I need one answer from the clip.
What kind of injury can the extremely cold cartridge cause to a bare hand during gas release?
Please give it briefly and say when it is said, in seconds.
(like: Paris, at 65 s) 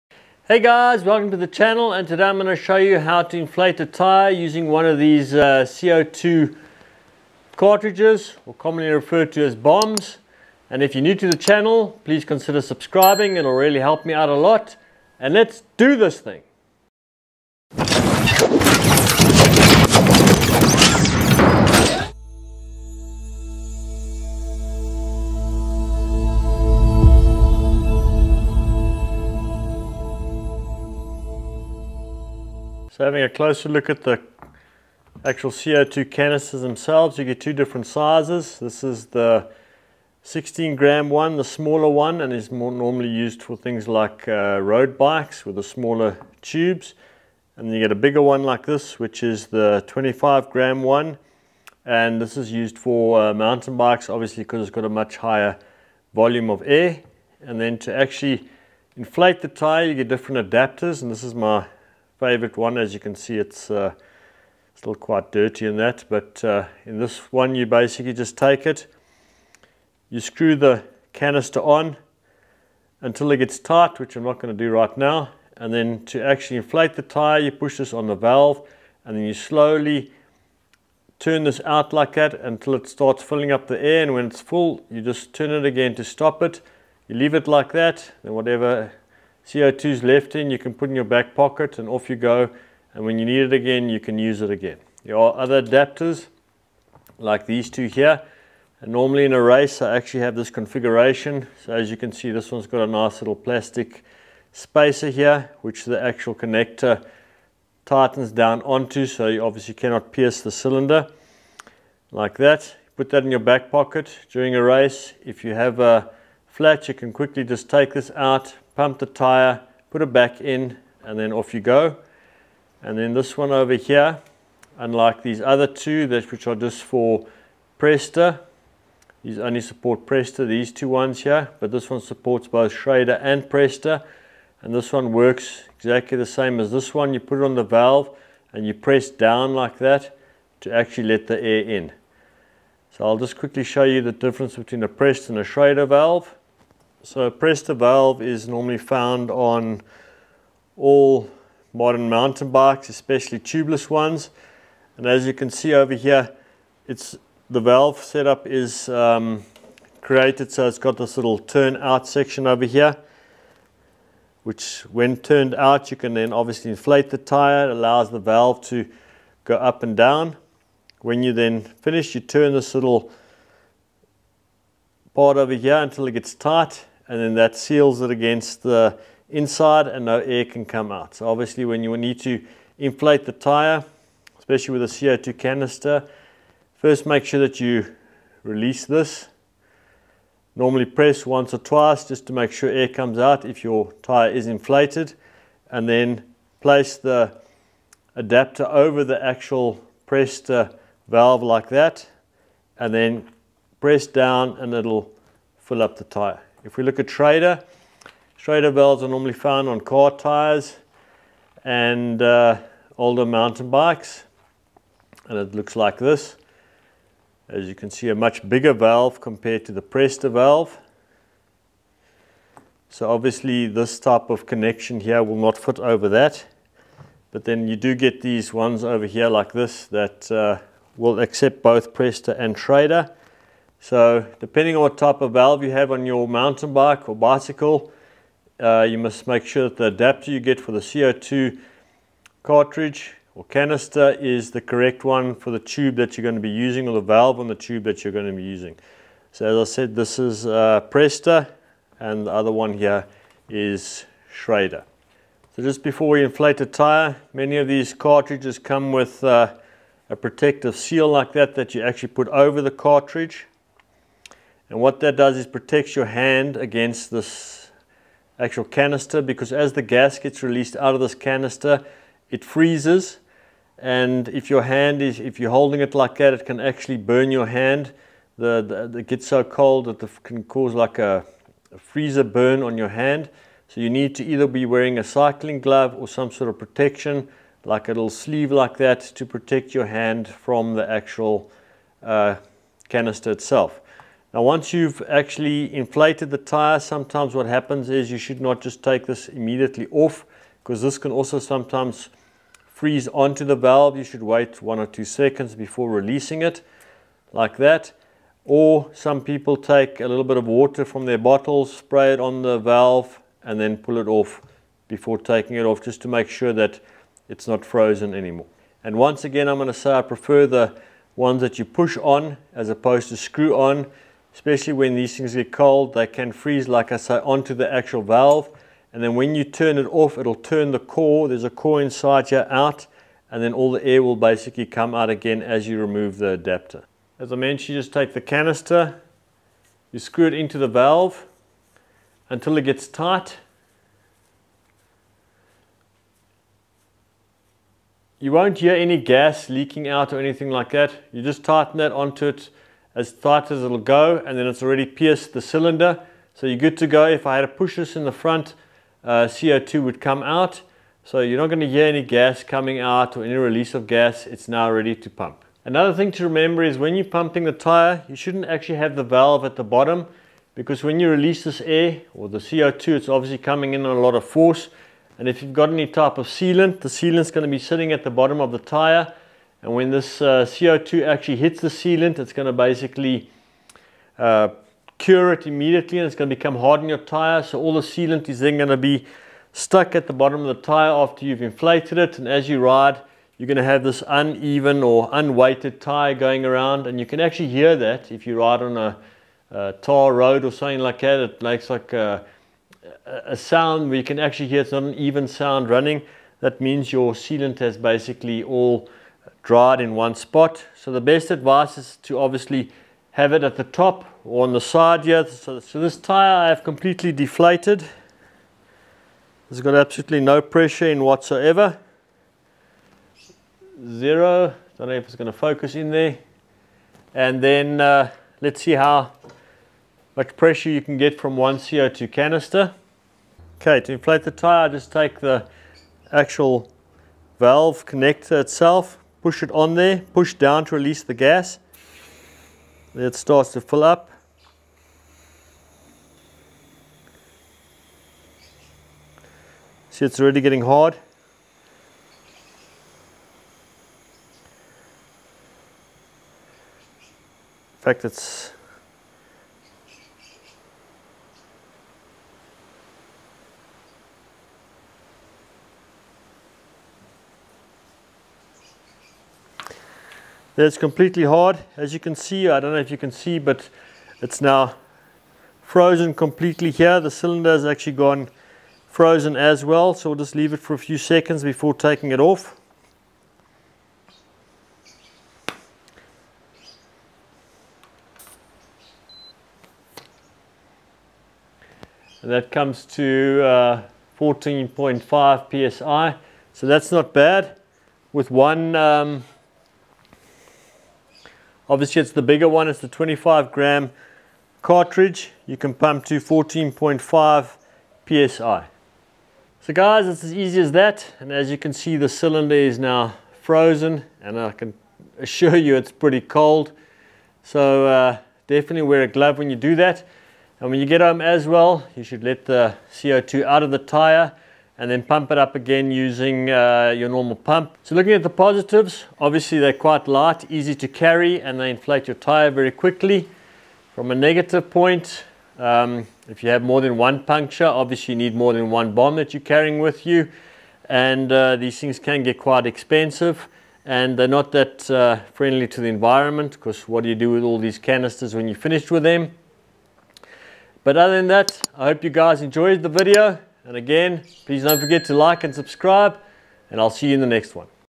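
freezer burn, at 281 s.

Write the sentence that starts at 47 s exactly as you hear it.
And you get a bigger one like this, which is the 25 gram one.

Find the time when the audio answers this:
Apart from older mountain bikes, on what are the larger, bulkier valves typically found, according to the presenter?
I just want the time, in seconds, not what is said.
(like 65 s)
209 s.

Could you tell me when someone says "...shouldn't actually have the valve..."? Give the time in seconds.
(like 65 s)
368 s.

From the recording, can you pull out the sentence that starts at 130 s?
these two ones here, but this one supports both Schrader and Presta.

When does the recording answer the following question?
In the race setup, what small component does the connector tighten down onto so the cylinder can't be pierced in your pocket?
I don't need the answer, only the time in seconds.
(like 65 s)
103 s.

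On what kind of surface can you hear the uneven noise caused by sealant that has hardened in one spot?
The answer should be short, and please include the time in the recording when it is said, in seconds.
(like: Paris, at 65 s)
tar road, at 399 s.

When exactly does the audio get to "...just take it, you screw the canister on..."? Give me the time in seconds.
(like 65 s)
68 s.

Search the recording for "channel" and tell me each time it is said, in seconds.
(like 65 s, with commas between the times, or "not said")
1 s, 11 s.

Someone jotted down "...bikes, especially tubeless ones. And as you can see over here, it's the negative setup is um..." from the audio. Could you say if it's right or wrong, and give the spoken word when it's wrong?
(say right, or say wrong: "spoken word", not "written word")
wrong: "valve", not "negative".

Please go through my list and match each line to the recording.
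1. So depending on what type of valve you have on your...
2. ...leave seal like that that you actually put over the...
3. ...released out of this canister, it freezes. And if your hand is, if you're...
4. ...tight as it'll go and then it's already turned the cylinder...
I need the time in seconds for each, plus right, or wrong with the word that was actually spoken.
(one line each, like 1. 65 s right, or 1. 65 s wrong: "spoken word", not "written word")
1. 233 s right
2. 260 s wrong: "protective", not "leave"
3. 270 s right
4. 353 s wrong: "pierced", not "turned".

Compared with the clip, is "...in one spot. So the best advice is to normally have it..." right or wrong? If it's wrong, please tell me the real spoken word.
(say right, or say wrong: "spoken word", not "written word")
wrong: "obviously", not "normally".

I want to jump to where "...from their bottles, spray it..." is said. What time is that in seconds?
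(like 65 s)
310 s.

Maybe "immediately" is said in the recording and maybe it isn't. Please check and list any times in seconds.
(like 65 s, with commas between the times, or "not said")
299 s, 385 s.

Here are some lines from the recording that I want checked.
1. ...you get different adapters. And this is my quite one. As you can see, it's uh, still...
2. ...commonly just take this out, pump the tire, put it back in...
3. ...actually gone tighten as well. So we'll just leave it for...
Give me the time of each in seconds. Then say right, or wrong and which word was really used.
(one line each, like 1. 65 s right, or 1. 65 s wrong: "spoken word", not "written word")
1. 59 s wrong: "favorite", not "quite"
2. 117 s wrong: "quickly", not "commonly"
3. 477 s wrong: "frozen", not "tighten".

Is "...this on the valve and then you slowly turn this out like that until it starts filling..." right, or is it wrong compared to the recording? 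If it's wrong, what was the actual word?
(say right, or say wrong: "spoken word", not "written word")
right.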